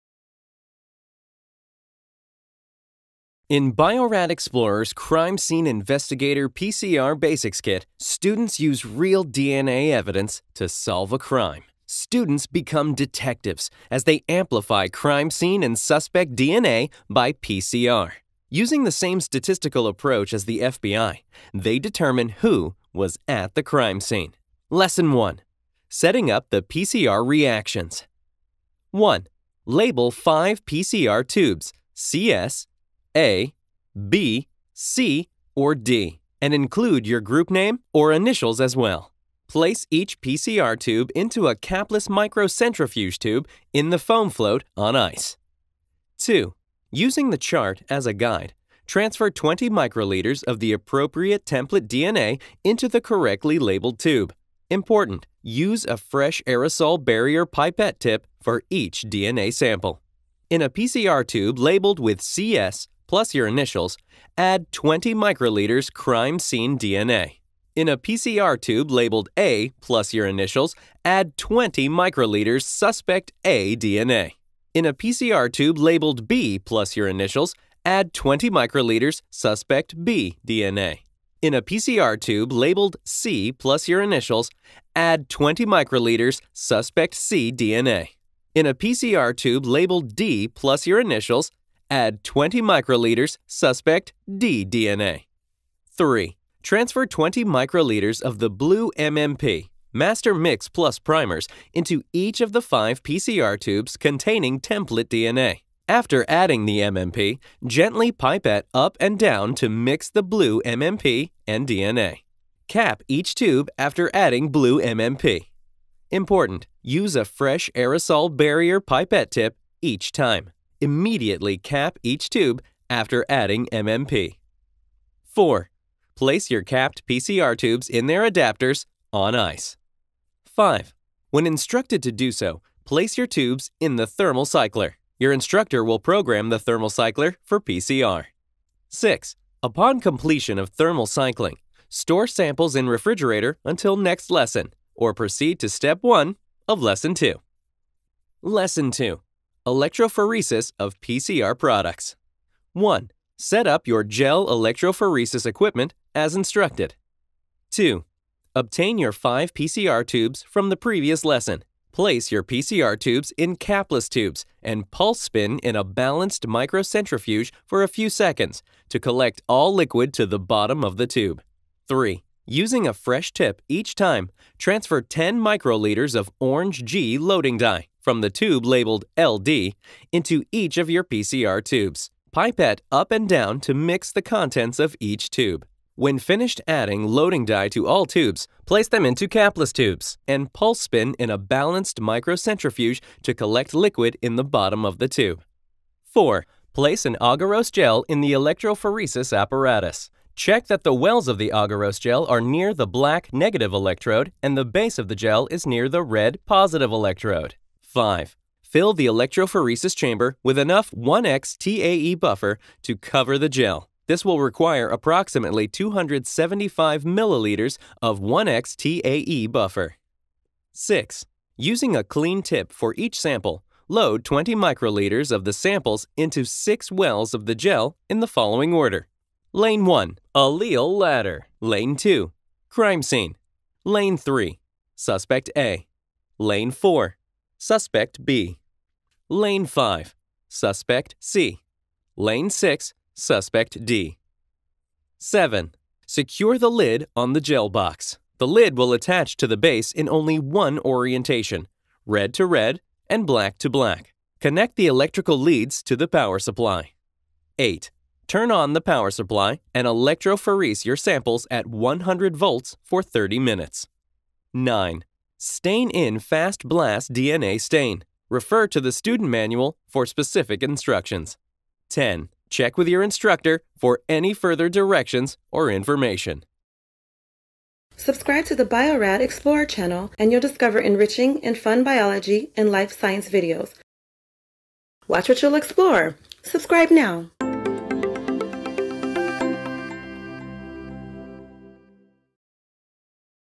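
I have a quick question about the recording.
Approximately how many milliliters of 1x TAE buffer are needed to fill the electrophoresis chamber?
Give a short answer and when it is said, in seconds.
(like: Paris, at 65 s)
275, at 215 s.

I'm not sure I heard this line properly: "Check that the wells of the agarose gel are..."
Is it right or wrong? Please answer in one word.
right.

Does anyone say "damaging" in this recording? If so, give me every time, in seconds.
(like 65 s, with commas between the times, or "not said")
not said.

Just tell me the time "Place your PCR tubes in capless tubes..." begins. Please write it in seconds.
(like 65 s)
161 s.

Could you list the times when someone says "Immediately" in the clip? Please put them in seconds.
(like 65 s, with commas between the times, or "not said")
120 s.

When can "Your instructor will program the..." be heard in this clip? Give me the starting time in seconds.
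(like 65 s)
135 s.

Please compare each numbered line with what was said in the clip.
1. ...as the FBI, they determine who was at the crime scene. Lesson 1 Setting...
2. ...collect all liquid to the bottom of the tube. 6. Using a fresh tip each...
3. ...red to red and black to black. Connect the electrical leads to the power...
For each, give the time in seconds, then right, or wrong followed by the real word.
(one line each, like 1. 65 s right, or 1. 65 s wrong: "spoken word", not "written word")
1. 20 s right
2. 168 s wrong: "3", not "6"
3. 252 s right.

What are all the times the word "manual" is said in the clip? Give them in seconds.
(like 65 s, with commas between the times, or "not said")
269 s.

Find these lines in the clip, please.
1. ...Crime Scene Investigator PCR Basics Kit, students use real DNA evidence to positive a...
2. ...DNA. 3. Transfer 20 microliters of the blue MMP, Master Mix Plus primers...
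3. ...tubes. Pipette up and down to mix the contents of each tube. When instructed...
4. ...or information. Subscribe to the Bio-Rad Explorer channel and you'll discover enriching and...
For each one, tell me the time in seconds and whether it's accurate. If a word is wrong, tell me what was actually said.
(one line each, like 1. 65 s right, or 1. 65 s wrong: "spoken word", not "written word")
1. 4 s wrong: "solve", not "positive"
2. 94 s right
3. 181 s wrong: "finished", not "instructed"
4. 275 s right.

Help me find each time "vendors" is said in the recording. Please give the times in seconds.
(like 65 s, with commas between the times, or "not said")
not said.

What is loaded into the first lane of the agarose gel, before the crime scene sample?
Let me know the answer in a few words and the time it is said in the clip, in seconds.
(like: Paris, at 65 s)
allele ladder, at 230 s.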